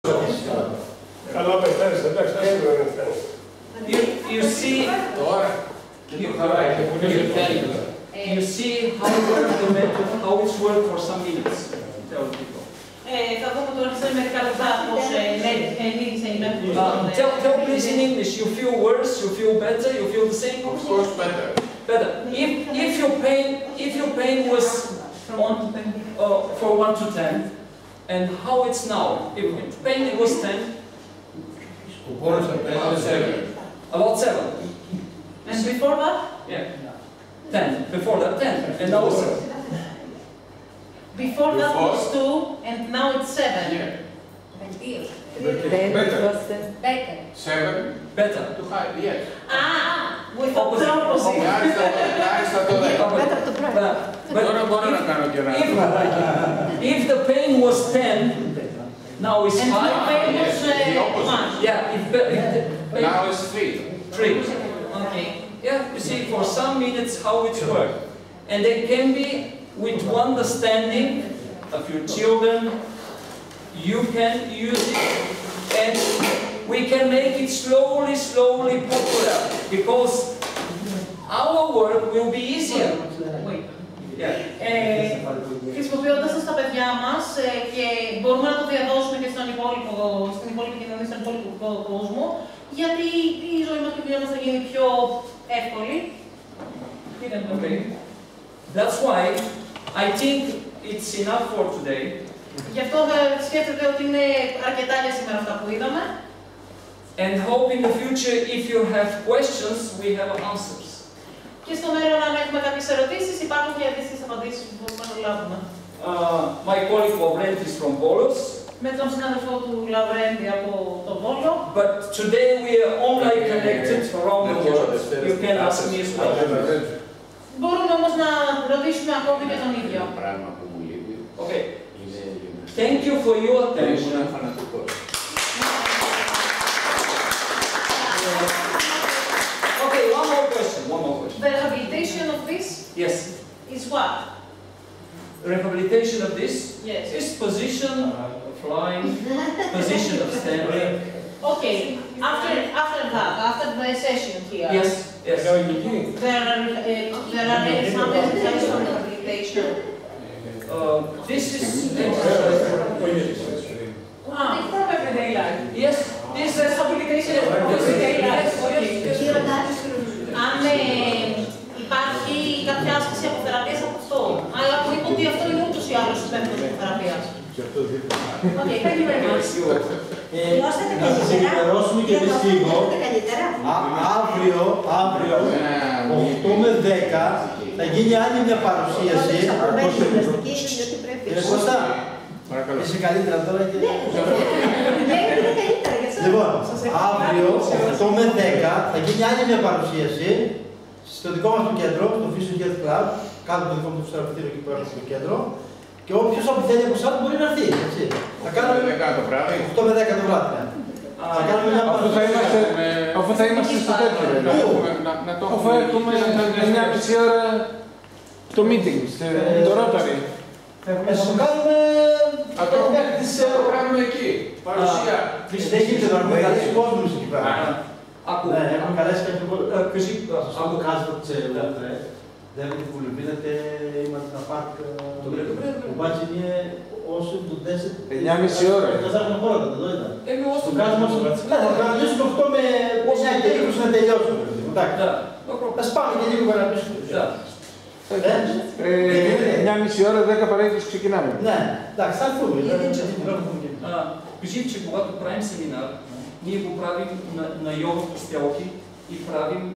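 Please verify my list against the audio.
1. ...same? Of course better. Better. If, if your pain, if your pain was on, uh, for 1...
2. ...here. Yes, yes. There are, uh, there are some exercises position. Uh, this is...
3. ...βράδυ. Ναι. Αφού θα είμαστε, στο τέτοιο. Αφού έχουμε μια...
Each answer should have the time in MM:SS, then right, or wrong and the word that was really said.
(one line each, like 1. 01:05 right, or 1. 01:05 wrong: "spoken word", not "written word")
1. 00:20 right
2. 02:34 wrong: "rehabilitation", not "position"
3. 03:30 right.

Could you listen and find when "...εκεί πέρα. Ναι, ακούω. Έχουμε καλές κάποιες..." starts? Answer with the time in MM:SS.
03:47.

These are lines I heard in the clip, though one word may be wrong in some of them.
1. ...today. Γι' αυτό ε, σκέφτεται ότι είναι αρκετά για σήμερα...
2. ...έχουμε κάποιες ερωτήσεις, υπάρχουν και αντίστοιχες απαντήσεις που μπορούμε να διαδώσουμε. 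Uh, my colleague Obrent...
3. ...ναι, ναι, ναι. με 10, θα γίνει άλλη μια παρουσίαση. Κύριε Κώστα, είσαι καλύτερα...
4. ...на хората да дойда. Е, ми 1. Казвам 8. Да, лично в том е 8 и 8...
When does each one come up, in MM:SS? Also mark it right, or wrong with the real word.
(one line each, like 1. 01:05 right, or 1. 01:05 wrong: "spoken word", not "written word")
1. 01:41 right
2. 01:52 wrong: "λάβουμε", not "διαδώσουμε"
3. 03:05 right
4. 03:59 wrong: "8", not "1".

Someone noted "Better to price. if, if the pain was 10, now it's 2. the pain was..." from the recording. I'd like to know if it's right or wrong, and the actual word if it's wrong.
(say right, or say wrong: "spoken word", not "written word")
wrong: "5", not "2".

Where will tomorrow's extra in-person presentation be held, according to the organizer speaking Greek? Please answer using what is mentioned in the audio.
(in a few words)
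Fusion Health Club.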